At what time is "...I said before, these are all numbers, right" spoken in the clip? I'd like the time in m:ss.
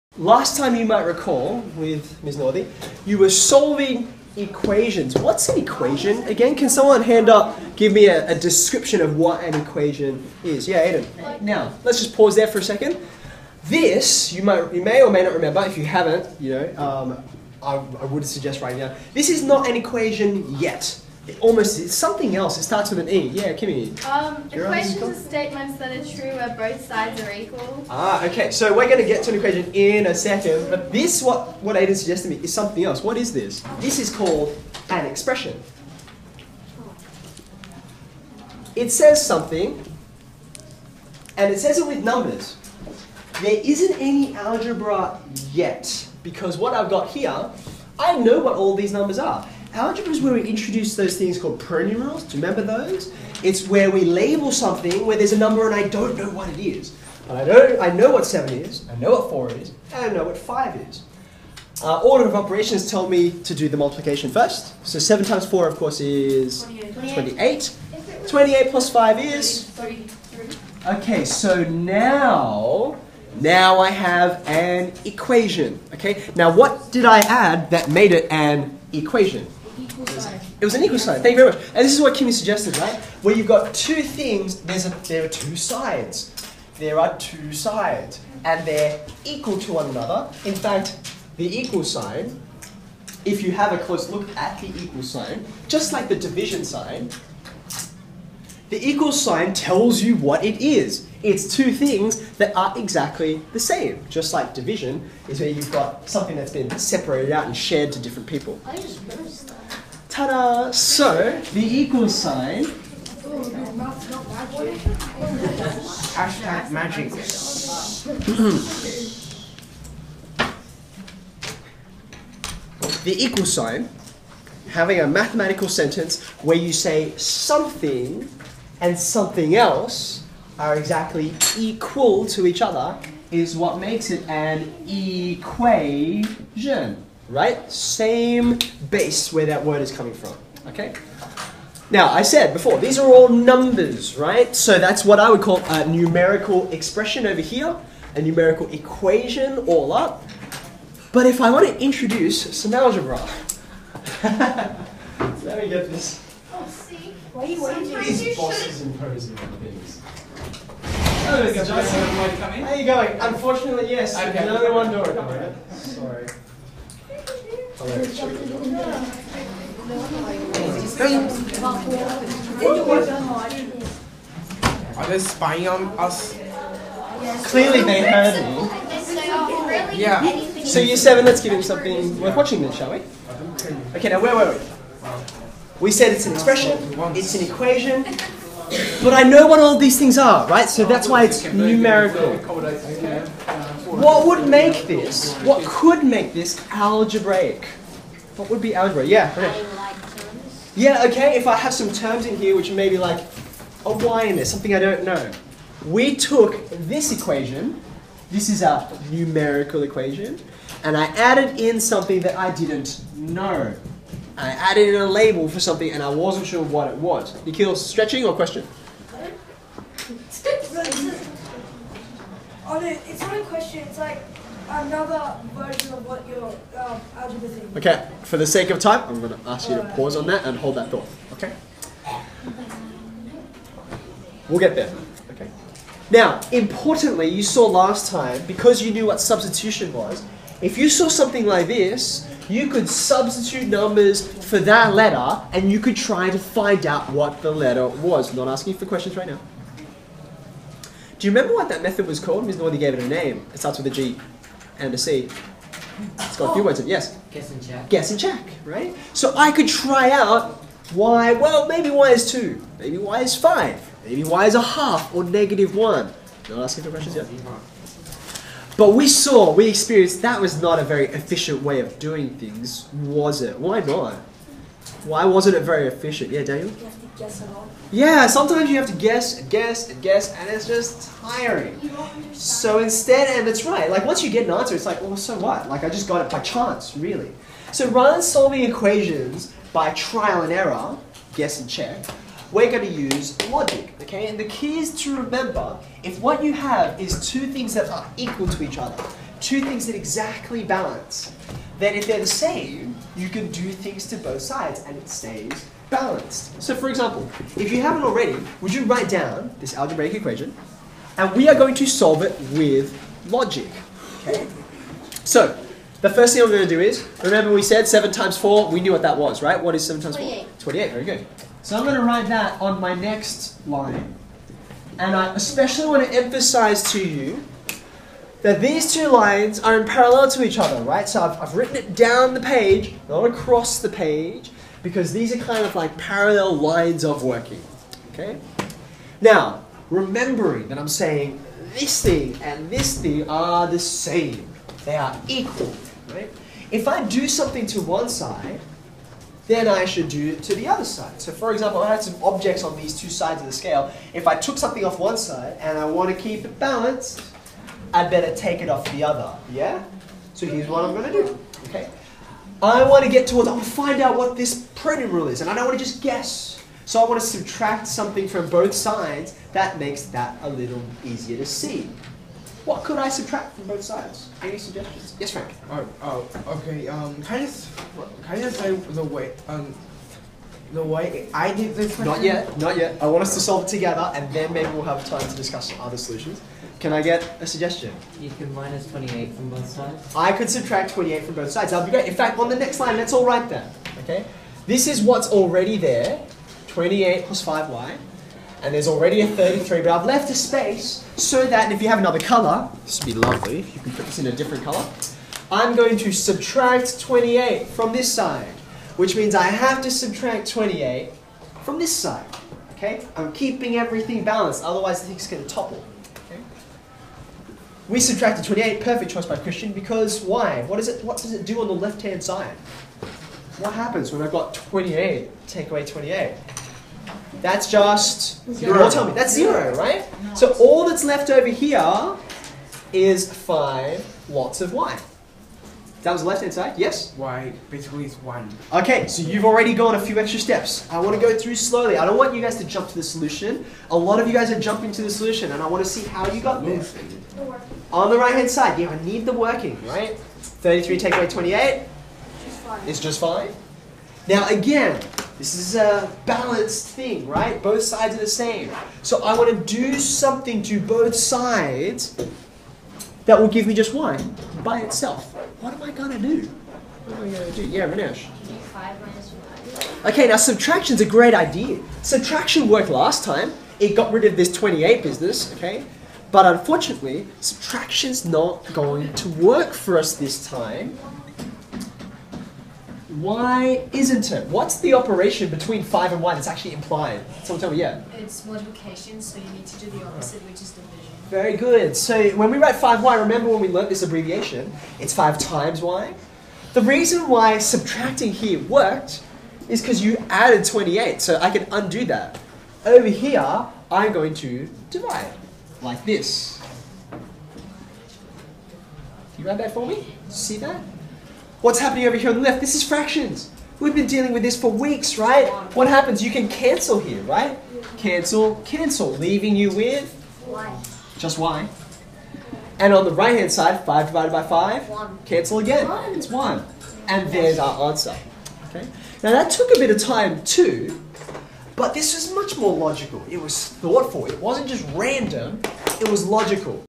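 2:22.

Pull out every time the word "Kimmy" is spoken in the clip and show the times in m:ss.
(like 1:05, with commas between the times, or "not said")
0:23, 1:22.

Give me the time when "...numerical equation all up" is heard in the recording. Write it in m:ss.
2:28.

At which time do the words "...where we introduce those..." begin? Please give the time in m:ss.
0:50.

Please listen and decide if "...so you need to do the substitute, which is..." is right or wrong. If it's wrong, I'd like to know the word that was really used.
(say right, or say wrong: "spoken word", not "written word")
wrong: "opposite", not "substitute".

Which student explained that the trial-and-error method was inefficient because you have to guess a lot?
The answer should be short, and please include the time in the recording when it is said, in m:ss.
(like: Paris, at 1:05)
Daniel, at 4:36.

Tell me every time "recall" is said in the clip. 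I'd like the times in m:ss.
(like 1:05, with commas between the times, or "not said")
0:01.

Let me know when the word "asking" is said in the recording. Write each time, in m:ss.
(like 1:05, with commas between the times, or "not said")
4:08, 4:26.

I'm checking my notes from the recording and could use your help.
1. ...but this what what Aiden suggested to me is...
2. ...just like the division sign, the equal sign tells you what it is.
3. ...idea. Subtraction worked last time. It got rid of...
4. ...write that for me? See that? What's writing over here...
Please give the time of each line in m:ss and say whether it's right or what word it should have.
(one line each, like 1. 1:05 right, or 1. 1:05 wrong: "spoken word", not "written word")
1. 0:30 right
2. 1:35 right
3. 7:51 right
4. 8:29 wrong: "happening", not "writing".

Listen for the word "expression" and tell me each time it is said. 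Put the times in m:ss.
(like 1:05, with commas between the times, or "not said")
0:35, 2:26, 3:06.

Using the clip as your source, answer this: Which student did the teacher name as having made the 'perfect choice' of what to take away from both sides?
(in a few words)
Christian.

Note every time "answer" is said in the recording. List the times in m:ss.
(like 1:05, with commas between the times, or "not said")
4:44, 8:47.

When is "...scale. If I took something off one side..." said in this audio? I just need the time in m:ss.
5:53.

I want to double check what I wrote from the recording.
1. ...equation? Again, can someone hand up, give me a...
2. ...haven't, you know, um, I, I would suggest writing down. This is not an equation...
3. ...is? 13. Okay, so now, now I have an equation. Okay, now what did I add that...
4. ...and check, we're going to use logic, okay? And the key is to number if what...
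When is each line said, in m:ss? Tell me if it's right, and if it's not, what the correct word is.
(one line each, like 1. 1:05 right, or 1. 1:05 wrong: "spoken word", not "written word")
1. 0:05 right
2. 0:15 right
3. 1:09 wrong: "33", not "13"
4. 4:51 wrong: "remember", not "number".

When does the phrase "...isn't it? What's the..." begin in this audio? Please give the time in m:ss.
8:03.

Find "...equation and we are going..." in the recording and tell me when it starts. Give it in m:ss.
5:10.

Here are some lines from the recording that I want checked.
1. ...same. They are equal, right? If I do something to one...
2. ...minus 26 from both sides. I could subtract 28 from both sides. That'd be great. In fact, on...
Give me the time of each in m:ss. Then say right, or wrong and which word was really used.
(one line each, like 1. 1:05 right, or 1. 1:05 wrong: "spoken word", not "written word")
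1. 5:43 right
2. 6:28 wrong: "28", not "26".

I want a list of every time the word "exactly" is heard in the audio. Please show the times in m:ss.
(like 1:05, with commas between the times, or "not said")
1:42, 2:10, 4:59.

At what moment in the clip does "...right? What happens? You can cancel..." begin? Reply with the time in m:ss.
8:35.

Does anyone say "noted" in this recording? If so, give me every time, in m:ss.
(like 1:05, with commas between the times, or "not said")
not said.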